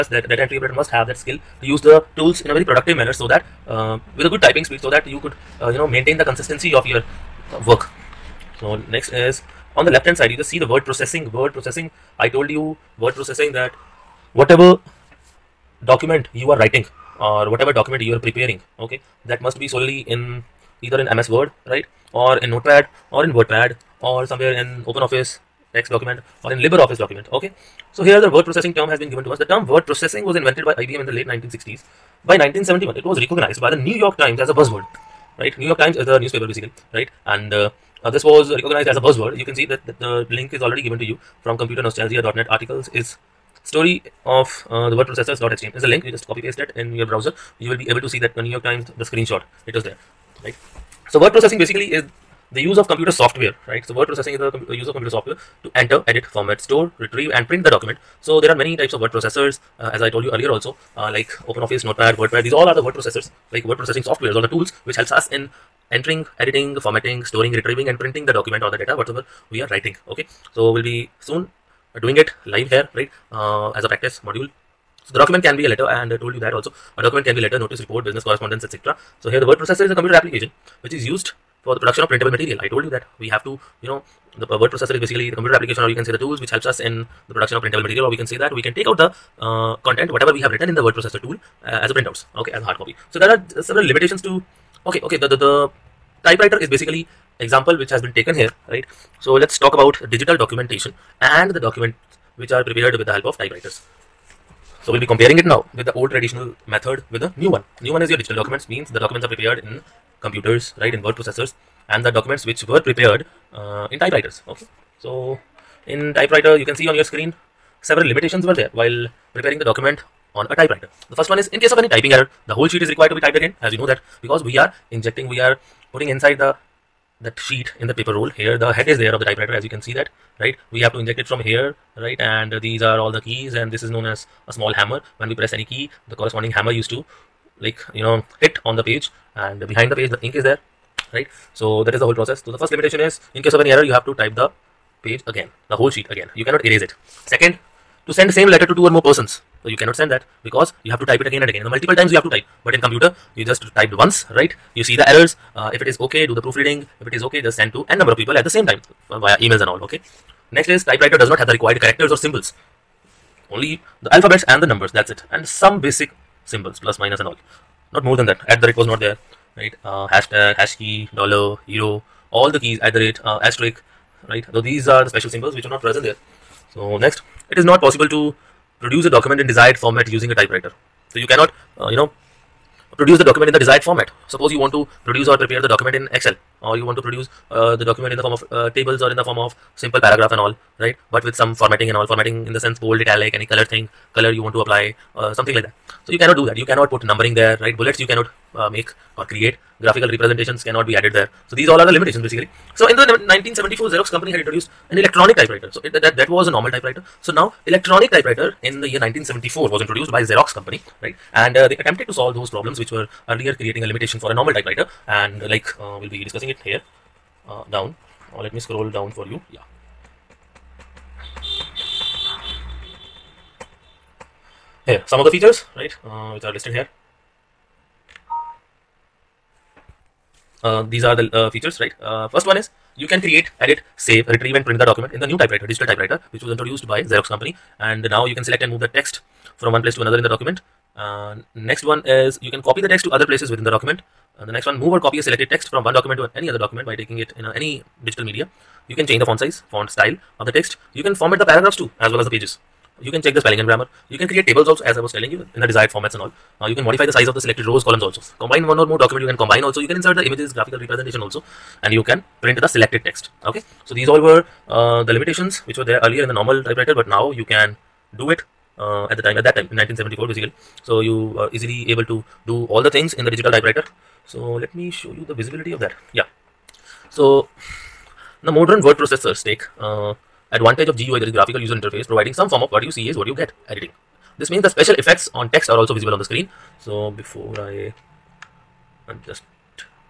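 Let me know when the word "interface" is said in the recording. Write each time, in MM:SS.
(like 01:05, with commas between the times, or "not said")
04:41.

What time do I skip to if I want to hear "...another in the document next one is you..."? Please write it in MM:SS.
04:00.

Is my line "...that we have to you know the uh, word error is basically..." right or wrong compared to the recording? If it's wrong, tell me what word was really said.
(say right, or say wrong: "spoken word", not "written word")
wrong: "processor", not "error".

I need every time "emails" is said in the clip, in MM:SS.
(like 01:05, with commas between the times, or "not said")
02:39.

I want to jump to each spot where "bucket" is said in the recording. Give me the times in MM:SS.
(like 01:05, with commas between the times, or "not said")
not said.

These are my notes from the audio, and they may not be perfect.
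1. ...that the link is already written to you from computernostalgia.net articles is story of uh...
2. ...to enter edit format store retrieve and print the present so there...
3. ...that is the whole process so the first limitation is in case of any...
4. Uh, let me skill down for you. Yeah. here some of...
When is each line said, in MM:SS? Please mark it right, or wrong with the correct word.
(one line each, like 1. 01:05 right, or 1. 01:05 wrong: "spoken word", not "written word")
1. 00:39 wrong: "given", not "written"
2. 00:55 wrong: "document", not "present"
3. 02:21 right
4. 03:38 wrong: "scroll", not "skill".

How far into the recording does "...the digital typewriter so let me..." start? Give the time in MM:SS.
04:33.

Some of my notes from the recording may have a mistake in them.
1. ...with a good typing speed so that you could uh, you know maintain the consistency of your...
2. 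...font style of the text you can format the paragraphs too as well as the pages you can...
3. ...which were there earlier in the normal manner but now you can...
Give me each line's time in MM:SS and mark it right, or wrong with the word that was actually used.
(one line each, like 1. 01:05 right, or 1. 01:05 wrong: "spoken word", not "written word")
1. 00:04 right
2. 04:09 right
3. 04:25 wrong: "typewriter", not "manner".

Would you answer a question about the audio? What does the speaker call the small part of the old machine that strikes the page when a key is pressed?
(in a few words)
a small hammer.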